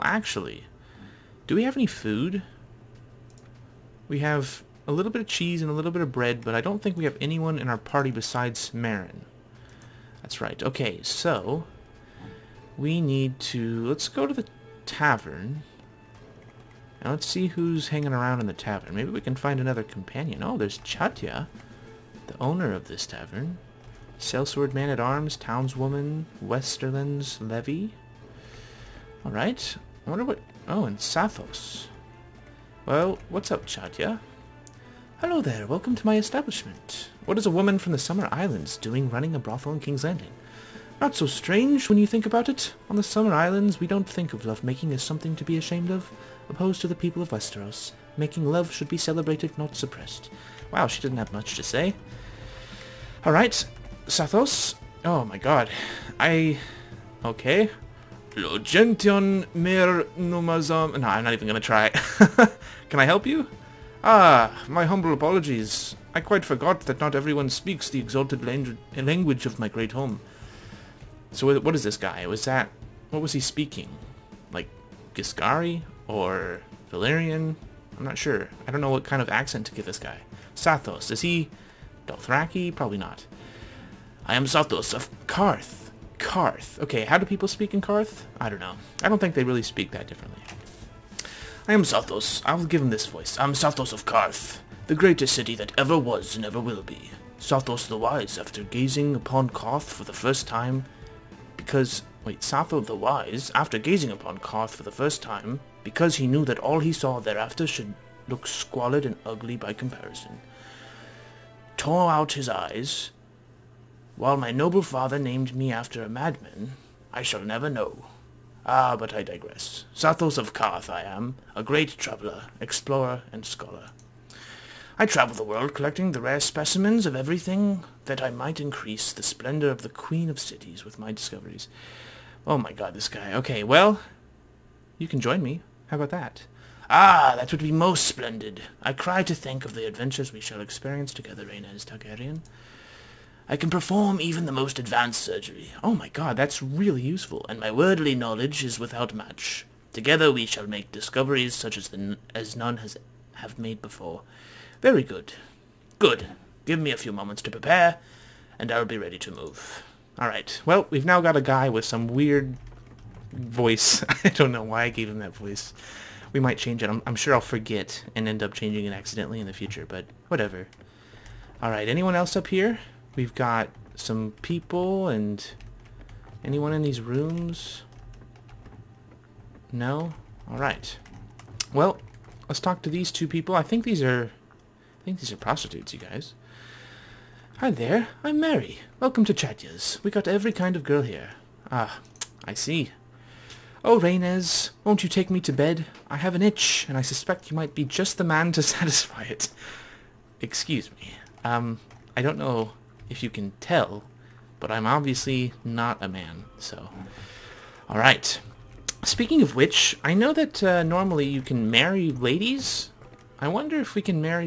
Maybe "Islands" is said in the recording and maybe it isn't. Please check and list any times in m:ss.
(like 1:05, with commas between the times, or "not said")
0:38, 0:43.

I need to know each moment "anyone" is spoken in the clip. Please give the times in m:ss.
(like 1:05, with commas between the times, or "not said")
0:07, 2:51, 2:56.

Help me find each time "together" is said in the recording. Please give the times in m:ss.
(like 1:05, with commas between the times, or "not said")
2:21, 2:29.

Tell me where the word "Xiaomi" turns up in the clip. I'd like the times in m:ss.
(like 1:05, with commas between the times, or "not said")
not said.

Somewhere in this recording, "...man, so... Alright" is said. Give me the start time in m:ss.
3:26.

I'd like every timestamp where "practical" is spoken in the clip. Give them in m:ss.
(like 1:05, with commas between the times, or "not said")
not said.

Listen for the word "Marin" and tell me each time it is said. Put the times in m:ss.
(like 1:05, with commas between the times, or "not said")
0:08.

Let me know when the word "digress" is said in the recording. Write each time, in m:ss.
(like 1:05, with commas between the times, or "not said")
1:59.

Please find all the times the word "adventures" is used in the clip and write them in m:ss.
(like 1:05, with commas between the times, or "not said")
2:19.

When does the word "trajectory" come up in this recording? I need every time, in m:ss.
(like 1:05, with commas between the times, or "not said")
not said.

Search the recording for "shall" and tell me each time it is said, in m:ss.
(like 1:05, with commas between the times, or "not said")
1:57, 2:20, 2:30.